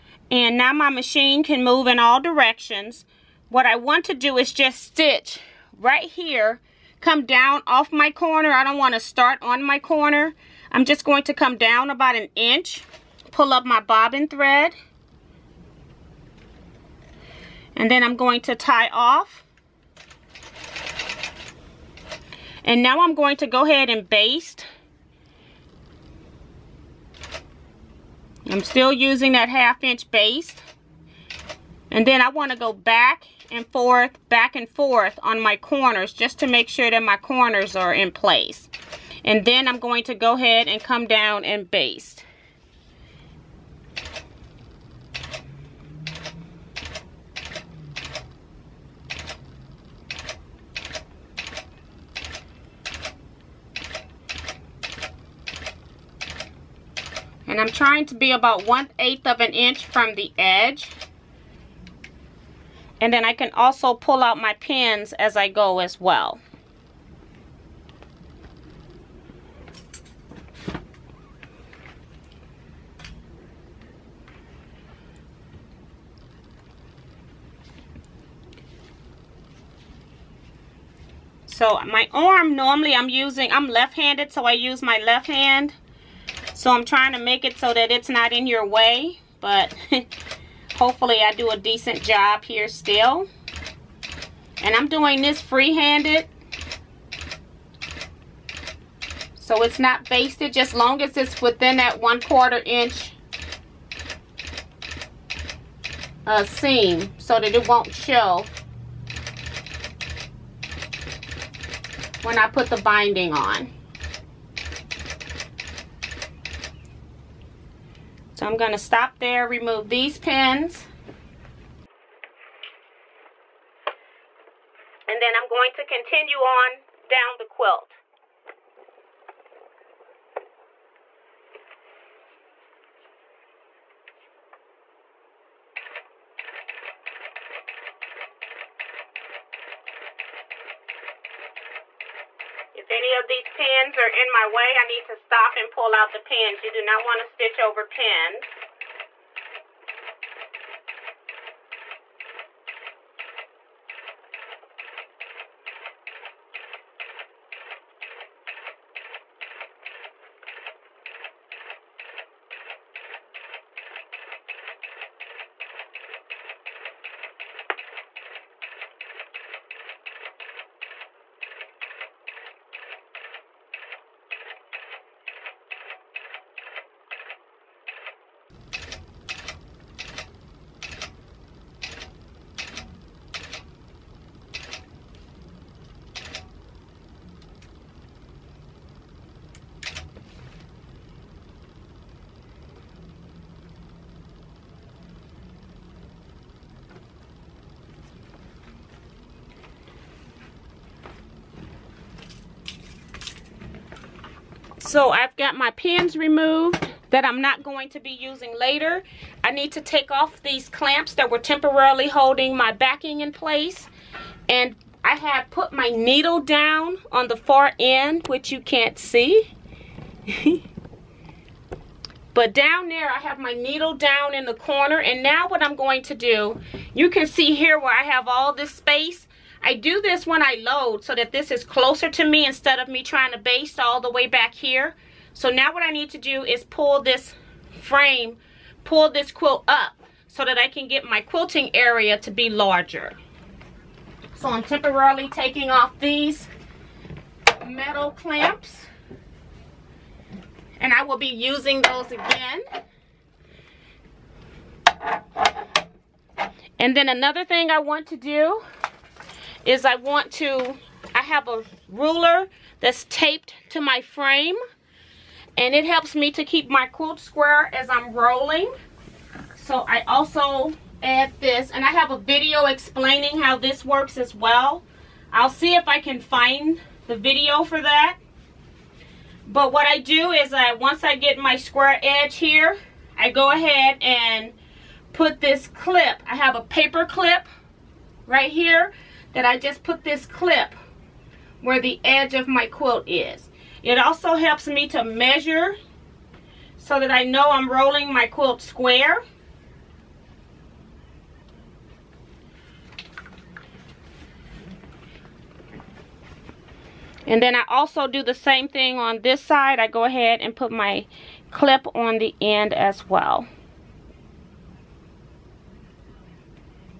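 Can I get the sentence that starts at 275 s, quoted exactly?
I'll see if I can find the video for that.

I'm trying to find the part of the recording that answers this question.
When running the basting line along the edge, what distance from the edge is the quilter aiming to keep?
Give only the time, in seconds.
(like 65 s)
58 s.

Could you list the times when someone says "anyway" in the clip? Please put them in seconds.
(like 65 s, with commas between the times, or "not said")
not said.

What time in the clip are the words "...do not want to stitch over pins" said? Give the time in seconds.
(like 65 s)
146 s.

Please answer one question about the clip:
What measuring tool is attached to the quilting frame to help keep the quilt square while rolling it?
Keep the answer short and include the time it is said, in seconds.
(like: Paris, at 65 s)
a ruler, at 261 s.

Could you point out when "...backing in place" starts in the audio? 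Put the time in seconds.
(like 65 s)
212 s.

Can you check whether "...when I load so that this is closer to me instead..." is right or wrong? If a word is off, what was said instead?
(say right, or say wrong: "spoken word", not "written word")
right.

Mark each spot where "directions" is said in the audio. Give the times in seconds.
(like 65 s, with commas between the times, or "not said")
2 s.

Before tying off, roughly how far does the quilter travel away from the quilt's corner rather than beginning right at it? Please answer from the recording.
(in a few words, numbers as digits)
about an inch.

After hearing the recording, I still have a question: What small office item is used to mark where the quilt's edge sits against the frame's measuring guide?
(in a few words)
a paper clip.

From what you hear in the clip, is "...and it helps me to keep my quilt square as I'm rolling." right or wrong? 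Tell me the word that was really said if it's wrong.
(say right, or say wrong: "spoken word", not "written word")
right.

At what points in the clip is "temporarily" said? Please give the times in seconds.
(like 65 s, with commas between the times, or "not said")
211 s, 244 s.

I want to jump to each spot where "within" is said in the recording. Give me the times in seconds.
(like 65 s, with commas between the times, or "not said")
101 s.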